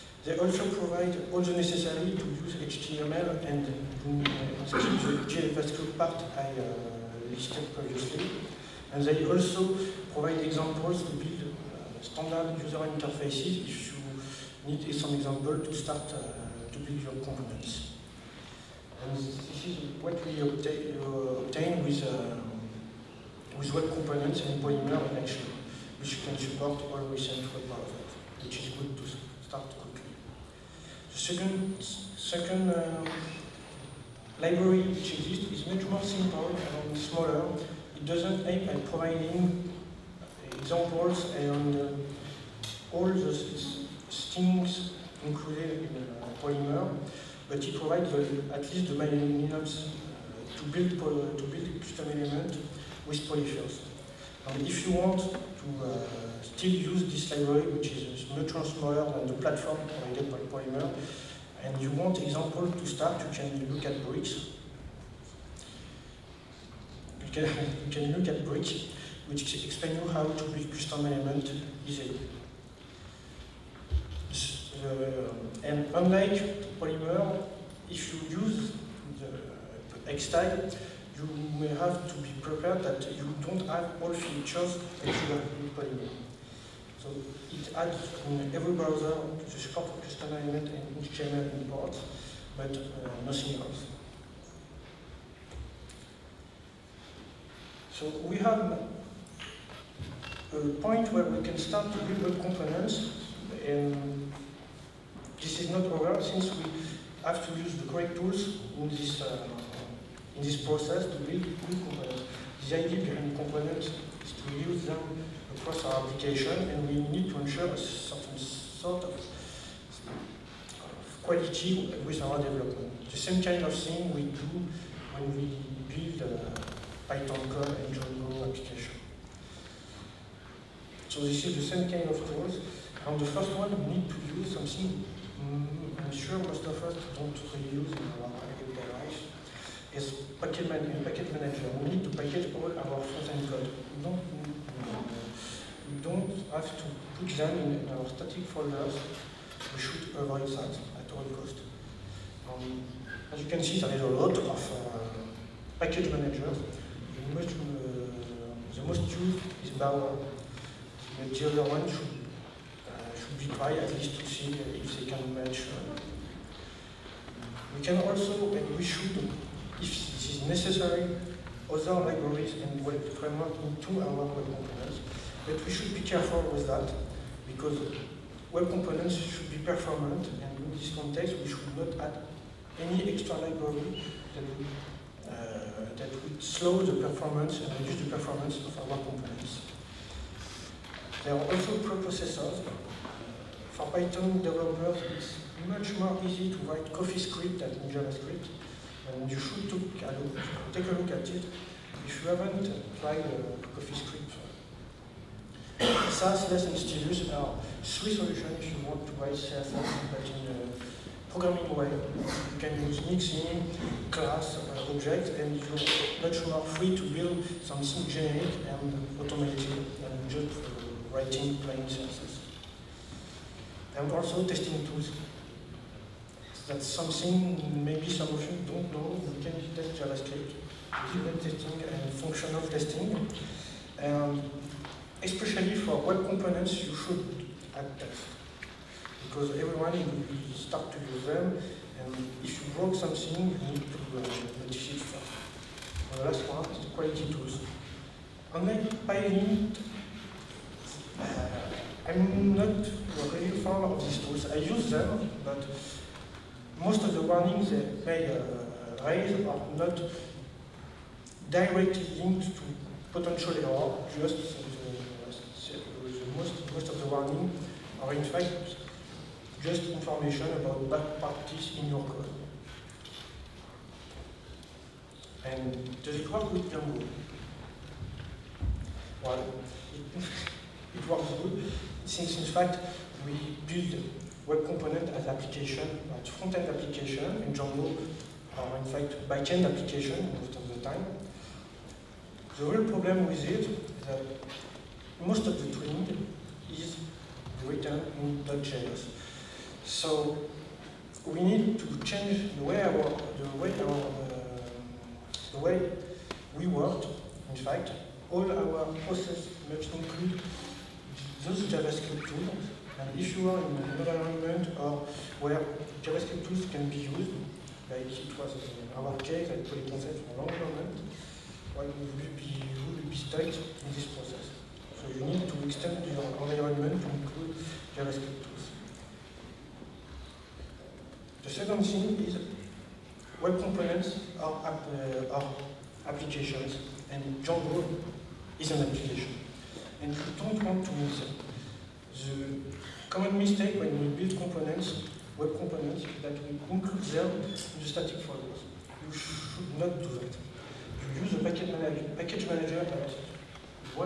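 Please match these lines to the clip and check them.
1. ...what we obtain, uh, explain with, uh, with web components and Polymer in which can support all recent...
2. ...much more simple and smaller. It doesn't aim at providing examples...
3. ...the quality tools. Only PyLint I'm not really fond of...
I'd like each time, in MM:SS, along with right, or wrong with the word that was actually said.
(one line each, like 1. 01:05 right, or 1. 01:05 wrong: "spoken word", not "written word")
1. 00:20 wrong: "obtain", not "explain"
2. 00:35 right
3. 04:06 right.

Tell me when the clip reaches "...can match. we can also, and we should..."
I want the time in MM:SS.
02:45.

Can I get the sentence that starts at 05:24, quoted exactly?
So you need to extend your environment to include JavaScript tools.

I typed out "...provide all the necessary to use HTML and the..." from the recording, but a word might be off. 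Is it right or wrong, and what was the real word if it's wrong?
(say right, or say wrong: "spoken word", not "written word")
right.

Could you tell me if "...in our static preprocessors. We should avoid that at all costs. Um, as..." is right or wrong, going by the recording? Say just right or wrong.
wrong.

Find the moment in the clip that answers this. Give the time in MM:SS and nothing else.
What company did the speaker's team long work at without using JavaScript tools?
05:19.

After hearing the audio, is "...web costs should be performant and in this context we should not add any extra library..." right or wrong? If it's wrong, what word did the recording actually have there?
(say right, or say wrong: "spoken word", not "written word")
wrong: "components", not "costs".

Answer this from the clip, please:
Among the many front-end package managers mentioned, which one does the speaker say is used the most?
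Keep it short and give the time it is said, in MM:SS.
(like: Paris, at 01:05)
Bower, at 02:39.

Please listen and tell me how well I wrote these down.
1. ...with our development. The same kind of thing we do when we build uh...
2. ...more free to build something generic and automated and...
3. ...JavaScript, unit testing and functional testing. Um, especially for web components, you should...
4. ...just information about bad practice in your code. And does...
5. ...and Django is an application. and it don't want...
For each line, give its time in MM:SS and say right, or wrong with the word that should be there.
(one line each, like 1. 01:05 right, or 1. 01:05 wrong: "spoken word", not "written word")
1. 02:02 right
2. 03:36 right
3. 03:49 right
4. 04:29 right
5. 05:37 right.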